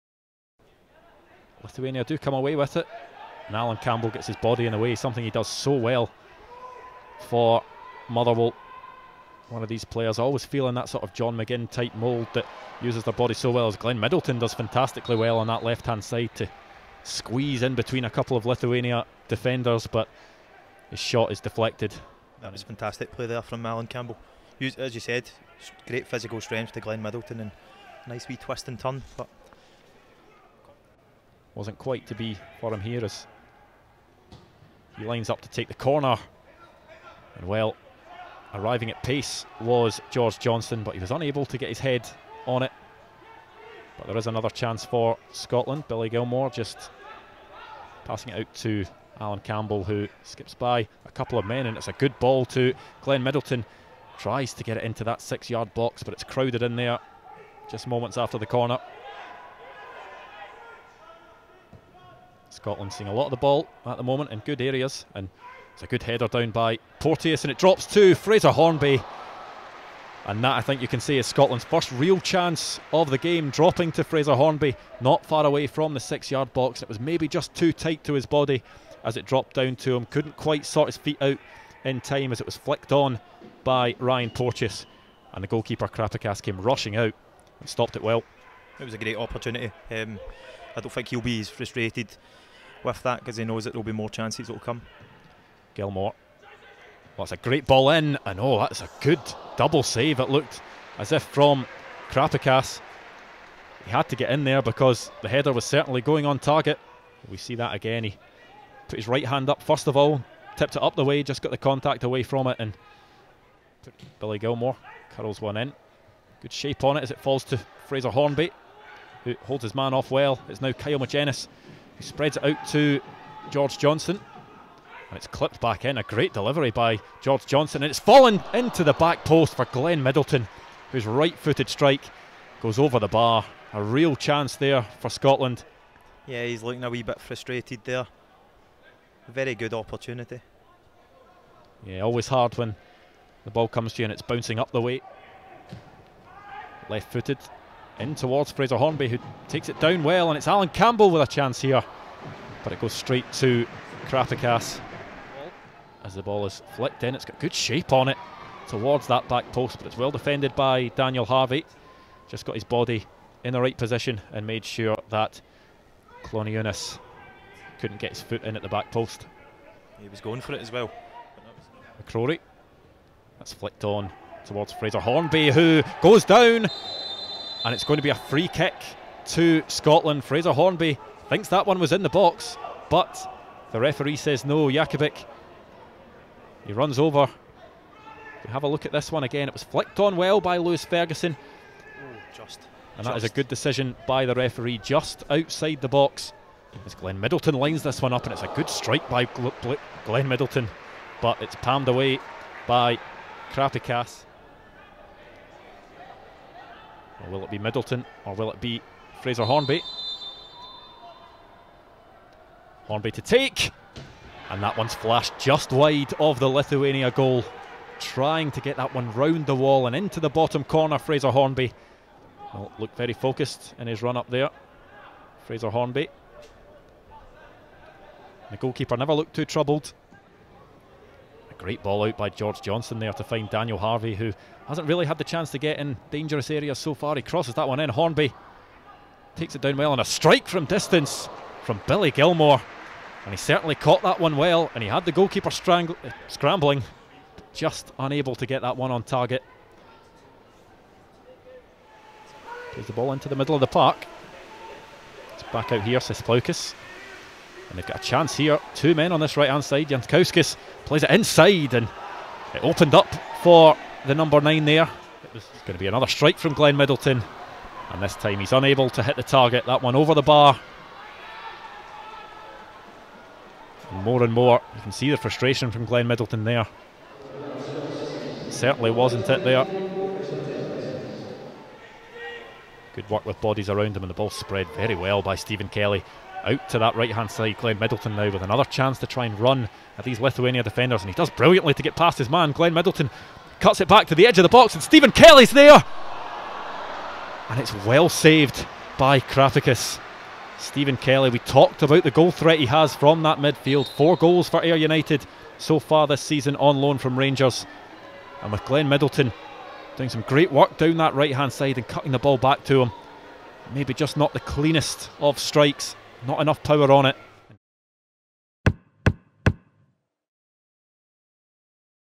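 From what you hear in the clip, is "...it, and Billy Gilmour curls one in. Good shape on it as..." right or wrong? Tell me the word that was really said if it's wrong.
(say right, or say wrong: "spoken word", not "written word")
right.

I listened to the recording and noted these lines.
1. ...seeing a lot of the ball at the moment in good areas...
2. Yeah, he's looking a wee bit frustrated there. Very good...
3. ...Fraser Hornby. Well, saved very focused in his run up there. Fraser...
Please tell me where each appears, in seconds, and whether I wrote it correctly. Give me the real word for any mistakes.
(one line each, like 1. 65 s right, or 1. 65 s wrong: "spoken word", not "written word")
1. 62 s right
2. 136 s right
3. 220 s wrong: "looked", not "saved".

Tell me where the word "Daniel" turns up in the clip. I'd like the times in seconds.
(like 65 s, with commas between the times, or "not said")
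160 s, 233 s.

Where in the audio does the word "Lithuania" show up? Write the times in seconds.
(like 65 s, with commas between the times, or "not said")
1 s, 18 s, 216 s, 290 s.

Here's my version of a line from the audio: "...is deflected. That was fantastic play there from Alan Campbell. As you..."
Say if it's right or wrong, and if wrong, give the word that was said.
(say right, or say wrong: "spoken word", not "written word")
right.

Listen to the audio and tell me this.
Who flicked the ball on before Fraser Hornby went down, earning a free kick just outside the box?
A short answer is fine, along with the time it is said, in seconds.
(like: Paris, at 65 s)
Lewis Ferguson, at 190 s.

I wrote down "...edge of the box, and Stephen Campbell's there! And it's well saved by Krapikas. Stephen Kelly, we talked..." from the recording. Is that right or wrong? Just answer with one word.
wrong.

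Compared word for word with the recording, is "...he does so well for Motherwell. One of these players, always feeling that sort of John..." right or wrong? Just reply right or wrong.
right.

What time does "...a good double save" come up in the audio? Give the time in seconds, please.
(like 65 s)
98 s.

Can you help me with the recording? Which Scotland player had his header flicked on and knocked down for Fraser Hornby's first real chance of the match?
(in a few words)
Ryan Porteous.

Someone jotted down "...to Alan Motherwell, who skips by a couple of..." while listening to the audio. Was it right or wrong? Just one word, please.
wrong.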